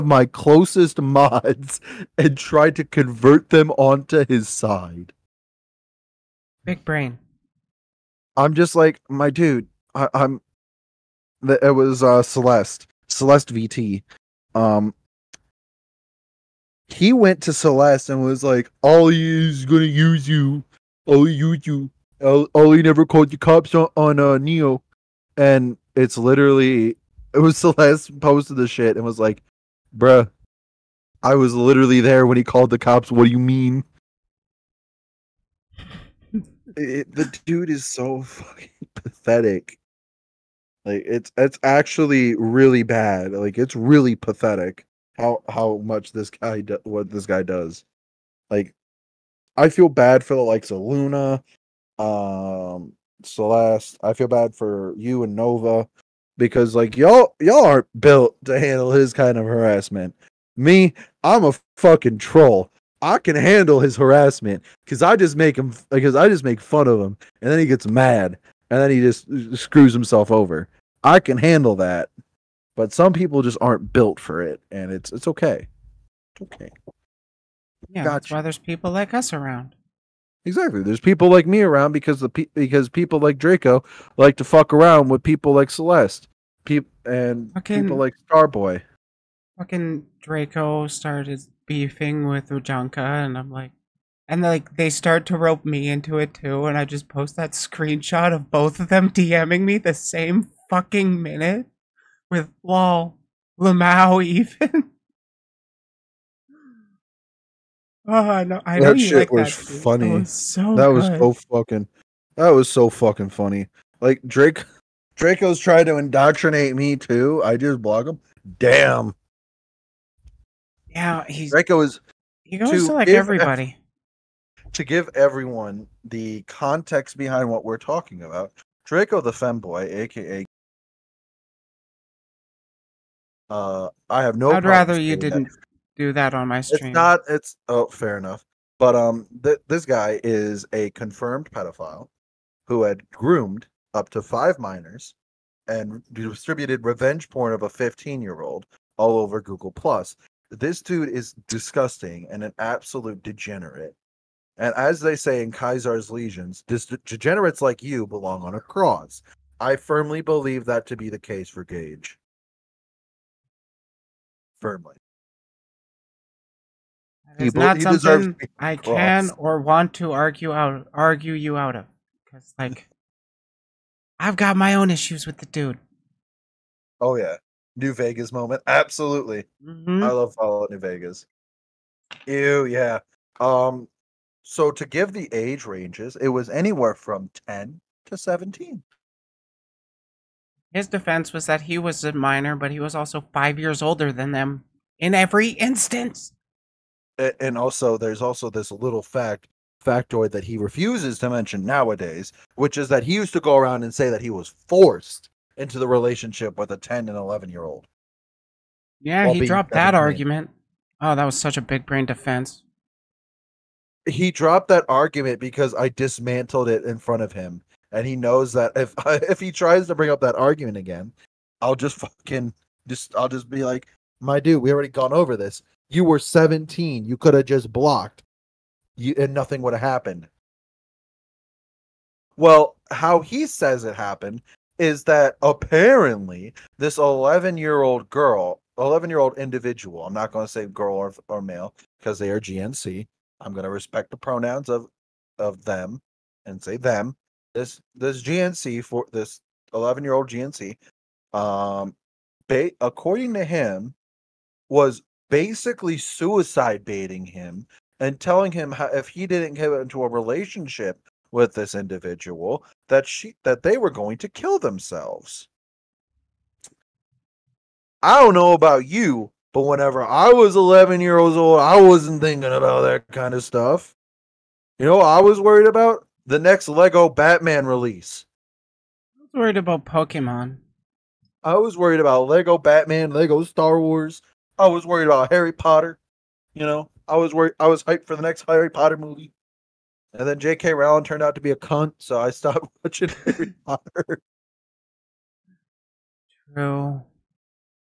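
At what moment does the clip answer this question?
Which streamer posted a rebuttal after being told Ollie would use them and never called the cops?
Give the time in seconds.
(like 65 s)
13 s.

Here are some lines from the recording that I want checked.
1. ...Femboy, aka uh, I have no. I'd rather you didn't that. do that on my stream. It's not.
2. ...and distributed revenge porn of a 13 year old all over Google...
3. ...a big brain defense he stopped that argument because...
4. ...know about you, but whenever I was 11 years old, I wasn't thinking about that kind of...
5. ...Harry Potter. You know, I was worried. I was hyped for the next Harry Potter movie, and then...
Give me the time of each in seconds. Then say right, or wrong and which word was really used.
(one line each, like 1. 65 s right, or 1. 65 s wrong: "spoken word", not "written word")
1. 129 s right
2. 145 s wrong: "15", not "13"
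3. 211 s wrong: "dropped", not "stopped"
4. 268 s right
5. 285 s right.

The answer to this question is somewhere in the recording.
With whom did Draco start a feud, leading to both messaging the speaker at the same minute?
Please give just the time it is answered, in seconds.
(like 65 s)
92 s.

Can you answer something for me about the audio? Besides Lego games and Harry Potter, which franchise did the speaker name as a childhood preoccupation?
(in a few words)
Pokemon.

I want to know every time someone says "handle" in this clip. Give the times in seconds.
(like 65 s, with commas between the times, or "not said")
58 s, 63 s, 71 s.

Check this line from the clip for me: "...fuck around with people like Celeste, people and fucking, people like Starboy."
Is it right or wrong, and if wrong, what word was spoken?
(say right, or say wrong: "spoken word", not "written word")
right.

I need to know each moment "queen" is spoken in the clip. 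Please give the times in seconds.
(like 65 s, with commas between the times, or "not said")
not said.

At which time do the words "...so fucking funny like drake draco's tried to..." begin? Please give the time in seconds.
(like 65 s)
112 s.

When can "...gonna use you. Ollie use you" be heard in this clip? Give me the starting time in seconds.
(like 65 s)
19 s.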